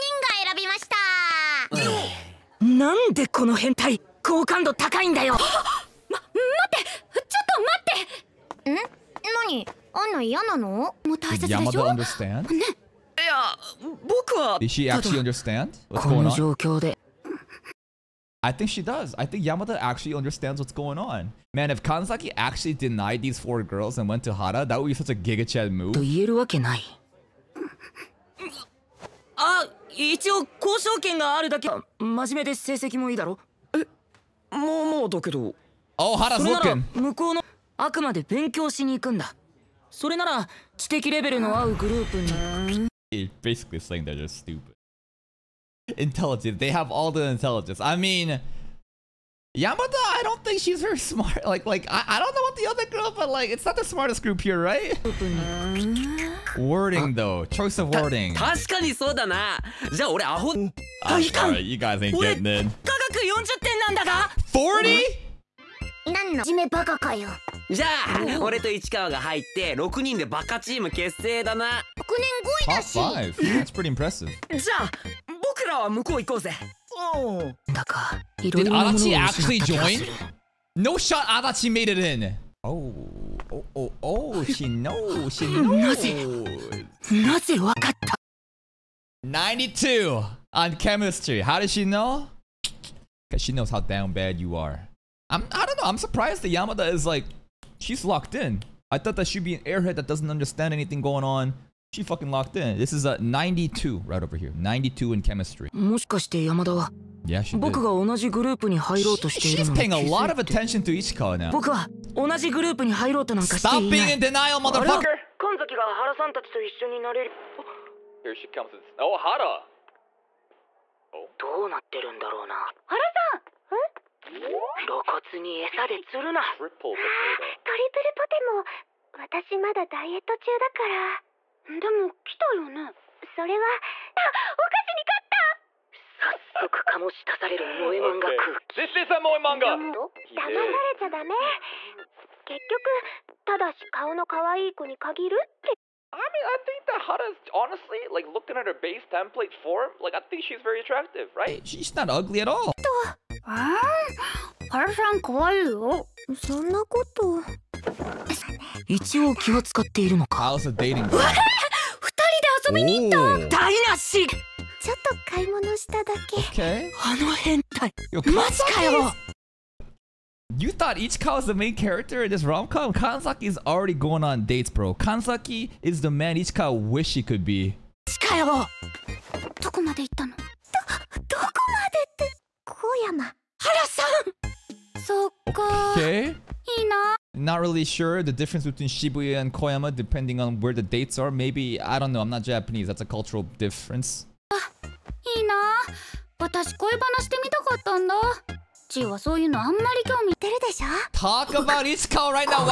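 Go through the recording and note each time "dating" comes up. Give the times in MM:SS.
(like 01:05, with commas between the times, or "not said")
02:40.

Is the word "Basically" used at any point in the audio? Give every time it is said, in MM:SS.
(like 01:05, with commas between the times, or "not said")
00:43.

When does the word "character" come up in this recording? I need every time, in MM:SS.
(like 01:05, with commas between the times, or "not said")
02:51.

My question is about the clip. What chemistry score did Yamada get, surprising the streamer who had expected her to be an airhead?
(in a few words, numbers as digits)
92.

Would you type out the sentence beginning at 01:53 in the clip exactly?
Stop being in denial, あ れ は motherfucker!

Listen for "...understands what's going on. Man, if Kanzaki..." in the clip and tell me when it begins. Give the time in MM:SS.
00:20.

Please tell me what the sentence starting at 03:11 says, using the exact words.
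Maybe, I don't know, I'm not Japanese.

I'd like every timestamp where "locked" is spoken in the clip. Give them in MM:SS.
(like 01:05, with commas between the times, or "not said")
01:38, 01:42.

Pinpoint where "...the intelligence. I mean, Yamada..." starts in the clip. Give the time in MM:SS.
00:47.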